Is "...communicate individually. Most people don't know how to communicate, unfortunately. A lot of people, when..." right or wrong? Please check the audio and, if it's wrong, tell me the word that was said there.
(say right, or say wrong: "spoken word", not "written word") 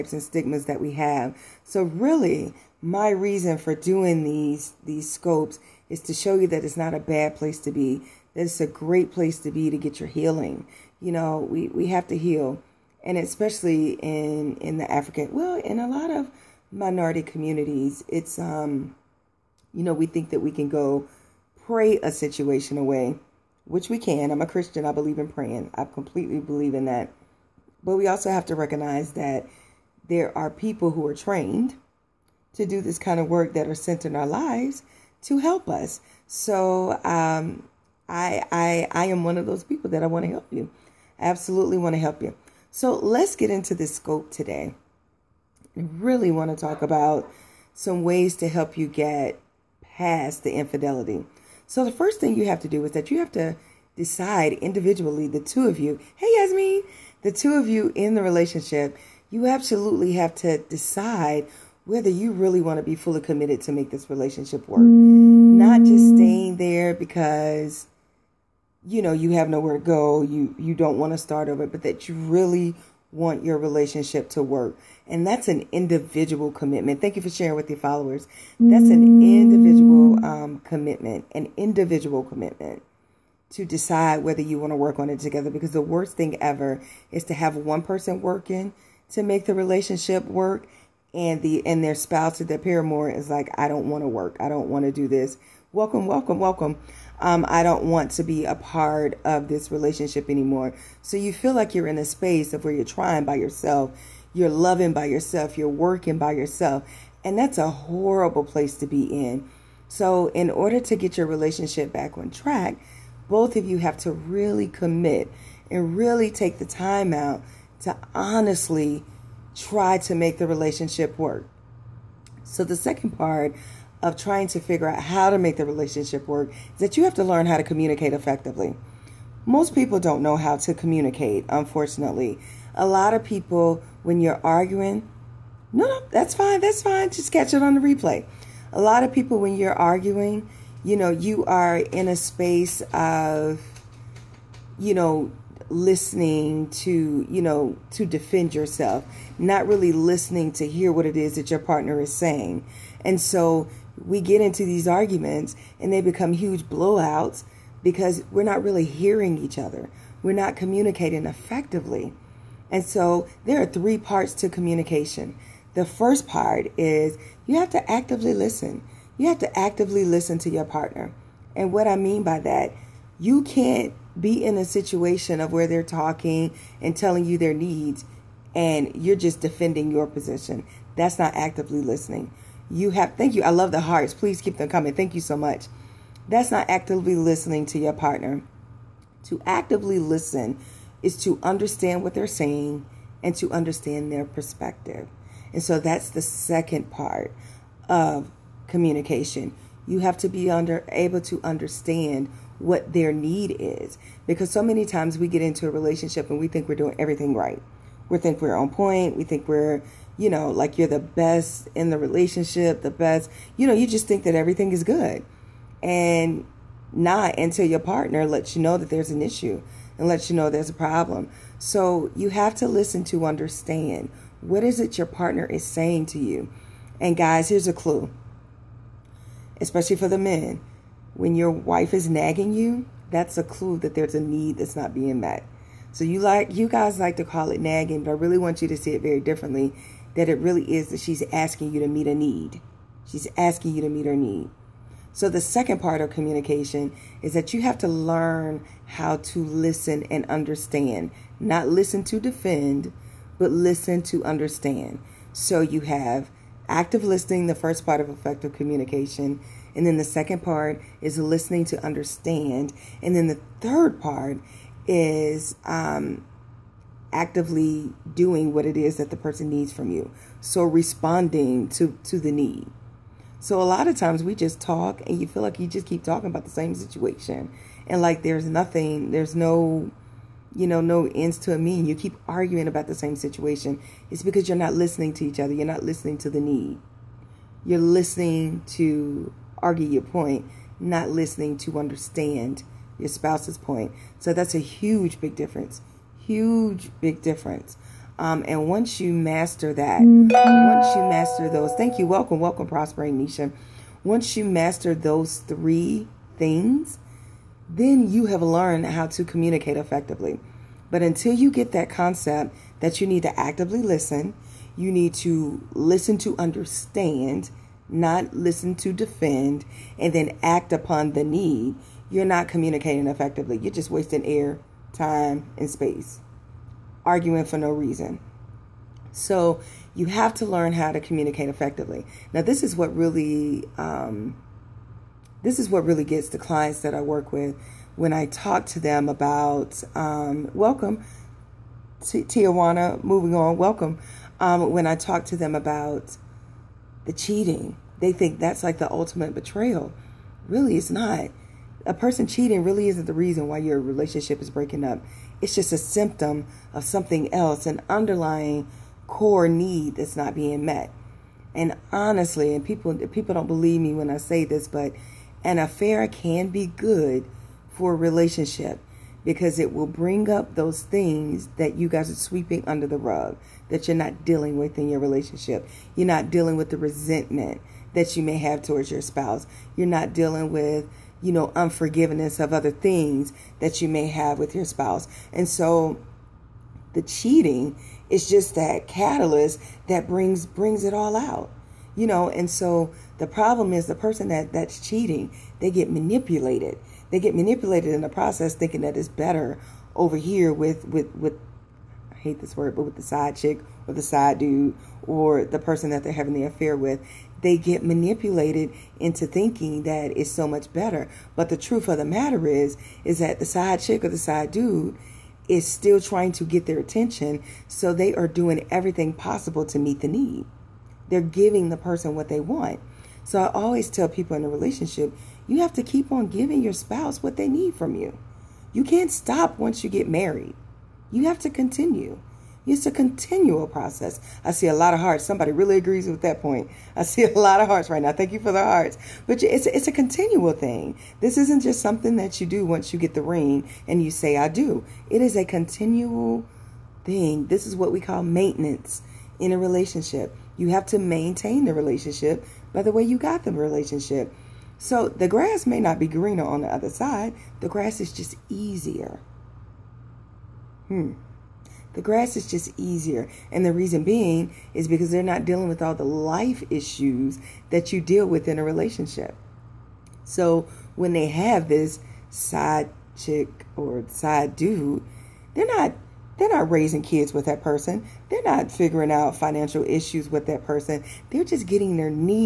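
wrong: "effectively", not "individually".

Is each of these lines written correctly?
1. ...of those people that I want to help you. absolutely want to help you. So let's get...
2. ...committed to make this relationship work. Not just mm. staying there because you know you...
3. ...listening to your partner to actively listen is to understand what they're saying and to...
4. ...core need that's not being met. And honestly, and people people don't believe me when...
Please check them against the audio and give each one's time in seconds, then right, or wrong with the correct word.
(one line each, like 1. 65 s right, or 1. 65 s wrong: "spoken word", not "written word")
1. 39 s right
2. 63 s right
3. 187 s right
4. 359 s right.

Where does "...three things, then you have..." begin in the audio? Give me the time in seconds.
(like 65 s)
305 s.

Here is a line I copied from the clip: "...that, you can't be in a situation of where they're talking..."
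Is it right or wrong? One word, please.
right.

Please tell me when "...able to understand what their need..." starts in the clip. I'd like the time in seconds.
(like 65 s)
200 s.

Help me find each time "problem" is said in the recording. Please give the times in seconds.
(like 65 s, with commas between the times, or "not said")
220 s, 393 s.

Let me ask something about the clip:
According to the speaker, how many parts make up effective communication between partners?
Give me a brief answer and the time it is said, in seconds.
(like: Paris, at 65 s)
3, at 163 s.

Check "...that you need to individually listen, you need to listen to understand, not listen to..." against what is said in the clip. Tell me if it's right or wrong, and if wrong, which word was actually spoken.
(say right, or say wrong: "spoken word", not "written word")
wrong: "actively", not "individually".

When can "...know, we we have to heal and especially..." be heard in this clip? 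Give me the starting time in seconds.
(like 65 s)
11 s.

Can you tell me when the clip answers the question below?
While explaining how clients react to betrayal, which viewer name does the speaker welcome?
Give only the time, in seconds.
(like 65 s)
342 s.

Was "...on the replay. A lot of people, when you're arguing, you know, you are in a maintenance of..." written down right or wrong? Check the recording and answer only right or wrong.
wrong.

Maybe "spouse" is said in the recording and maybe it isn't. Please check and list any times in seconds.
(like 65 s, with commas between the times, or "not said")
91 s, 293 s, 379 s, 384 s, 426 s.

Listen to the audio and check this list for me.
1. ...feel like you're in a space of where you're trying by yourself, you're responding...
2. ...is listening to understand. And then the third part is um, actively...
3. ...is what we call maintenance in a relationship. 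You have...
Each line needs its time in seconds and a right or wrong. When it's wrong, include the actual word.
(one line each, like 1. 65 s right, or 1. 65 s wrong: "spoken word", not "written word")
1. 101 s wrong: "loving", not "responding"
2. 261 s right
3. 447 s right.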